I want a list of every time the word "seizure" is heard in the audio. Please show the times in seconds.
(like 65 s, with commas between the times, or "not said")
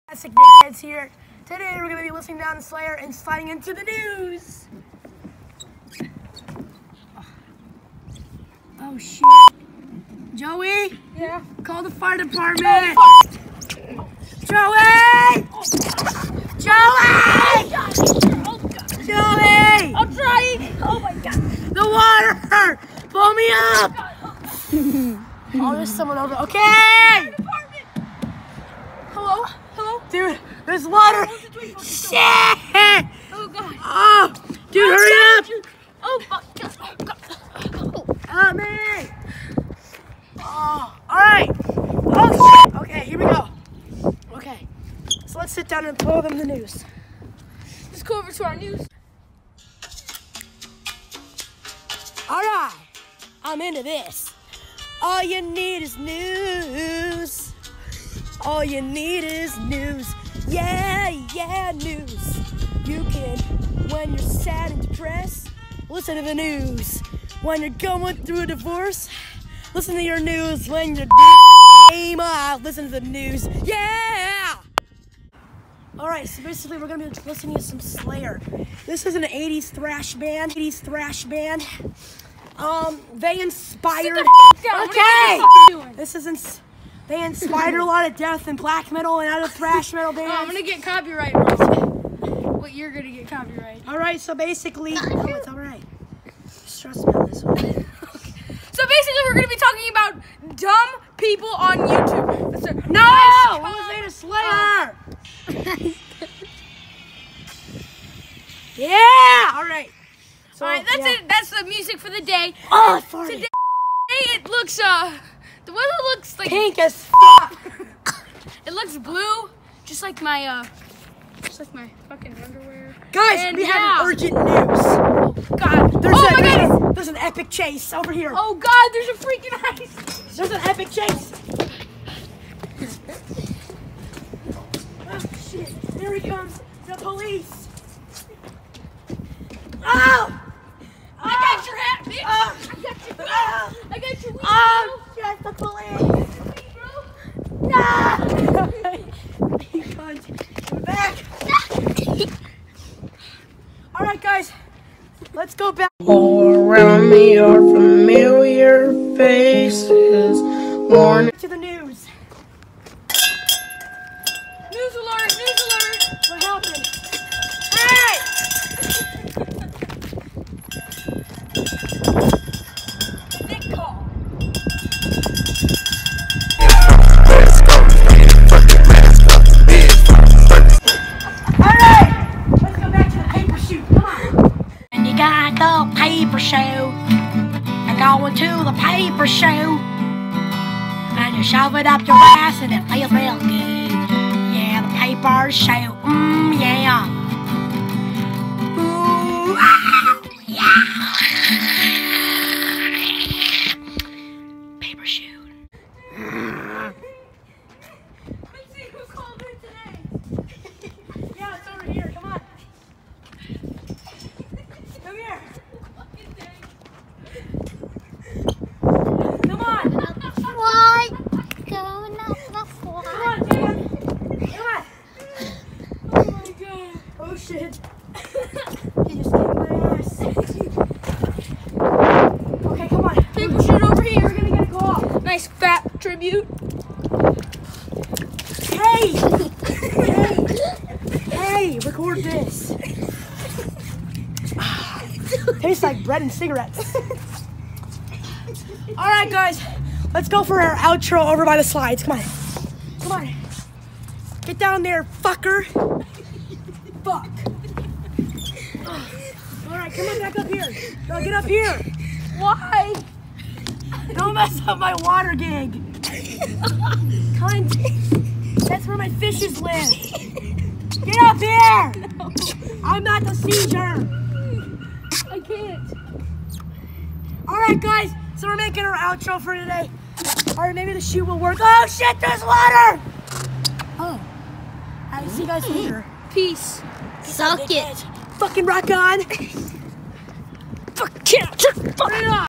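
273 s.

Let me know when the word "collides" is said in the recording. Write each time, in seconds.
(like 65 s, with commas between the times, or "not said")
not said.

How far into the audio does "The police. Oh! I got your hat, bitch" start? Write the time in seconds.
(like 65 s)
136 s.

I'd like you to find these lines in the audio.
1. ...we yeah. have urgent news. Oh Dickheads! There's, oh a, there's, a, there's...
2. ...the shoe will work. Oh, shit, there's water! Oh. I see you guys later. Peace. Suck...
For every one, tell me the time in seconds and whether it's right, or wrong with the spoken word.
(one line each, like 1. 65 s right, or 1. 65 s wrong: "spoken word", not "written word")
1. 123 s wrong: "God", not "Dickheads"
2. 280 s right.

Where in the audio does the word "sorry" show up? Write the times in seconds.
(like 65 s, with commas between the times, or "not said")
35 s, 113 s.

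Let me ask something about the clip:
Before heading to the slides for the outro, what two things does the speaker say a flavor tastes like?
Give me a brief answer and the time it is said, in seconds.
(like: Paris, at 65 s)
bread and cigarettes, at 246 s.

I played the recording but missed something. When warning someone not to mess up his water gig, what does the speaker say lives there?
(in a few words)
my fishes.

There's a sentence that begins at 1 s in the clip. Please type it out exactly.
Today we're going to be listening down the Slayer and sliding into the news.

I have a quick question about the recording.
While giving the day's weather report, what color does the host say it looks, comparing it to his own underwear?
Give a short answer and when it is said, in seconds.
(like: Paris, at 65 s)
blue, at 118 s.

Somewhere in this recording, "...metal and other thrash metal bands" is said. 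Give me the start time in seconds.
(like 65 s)
88 s.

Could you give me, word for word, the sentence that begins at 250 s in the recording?
Let's go for our outro over by the slides.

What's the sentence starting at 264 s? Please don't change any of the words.
Don't mess up my water gig.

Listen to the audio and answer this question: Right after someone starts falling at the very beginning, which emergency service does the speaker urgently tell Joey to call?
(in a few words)
fire department.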